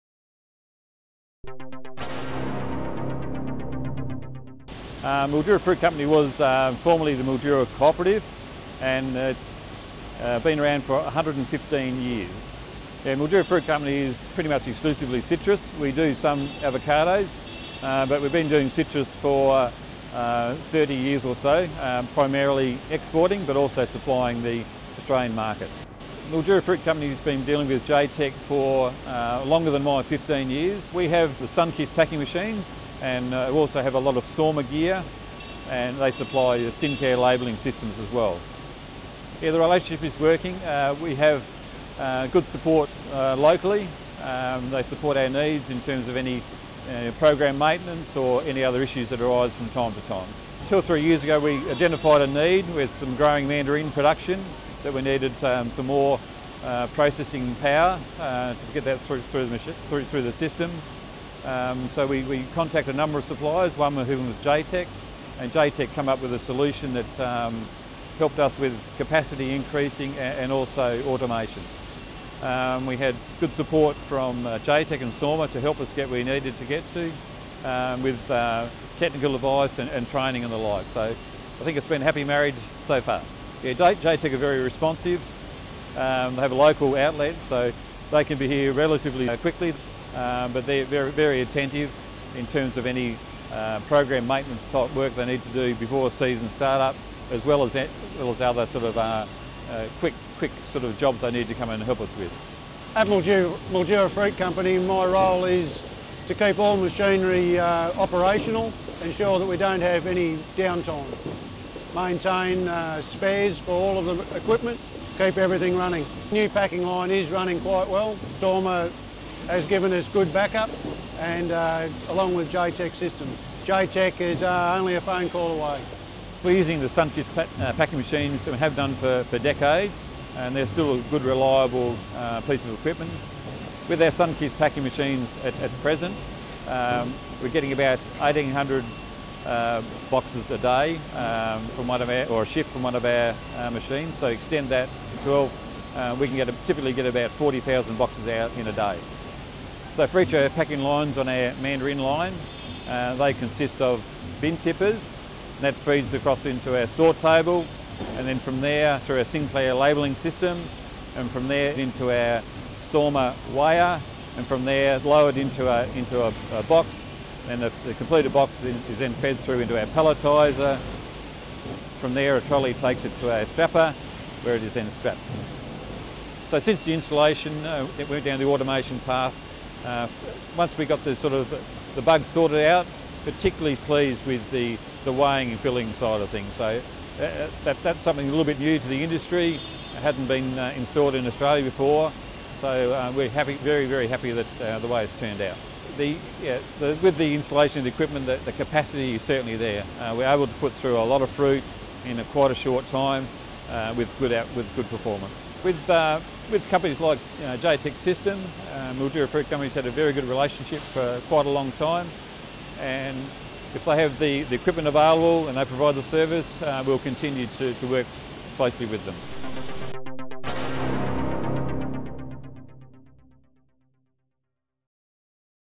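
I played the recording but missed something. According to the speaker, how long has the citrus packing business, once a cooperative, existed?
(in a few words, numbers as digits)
115 years.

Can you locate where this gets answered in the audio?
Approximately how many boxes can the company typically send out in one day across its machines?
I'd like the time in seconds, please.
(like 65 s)
147 s.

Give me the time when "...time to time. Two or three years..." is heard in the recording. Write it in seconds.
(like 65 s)
49 s.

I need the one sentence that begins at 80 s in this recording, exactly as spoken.
So I think it's been a happy marriage so far yeah, J-Tech are very responsive.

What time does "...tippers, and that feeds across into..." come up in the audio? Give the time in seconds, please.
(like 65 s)
154 s.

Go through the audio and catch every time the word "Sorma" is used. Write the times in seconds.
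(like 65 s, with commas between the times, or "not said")
34 s, 75 s, 162 s.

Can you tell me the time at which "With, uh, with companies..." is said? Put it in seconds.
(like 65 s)
205 s.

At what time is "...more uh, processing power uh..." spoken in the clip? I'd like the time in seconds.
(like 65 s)
55 s.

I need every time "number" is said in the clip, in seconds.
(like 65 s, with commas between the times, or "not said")
62 s.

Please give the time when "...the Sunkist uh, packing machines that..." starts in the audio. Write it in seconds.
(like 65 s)
126 s.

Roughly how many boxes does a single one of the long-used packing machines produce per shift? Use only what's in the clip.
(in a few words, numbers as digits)
1800.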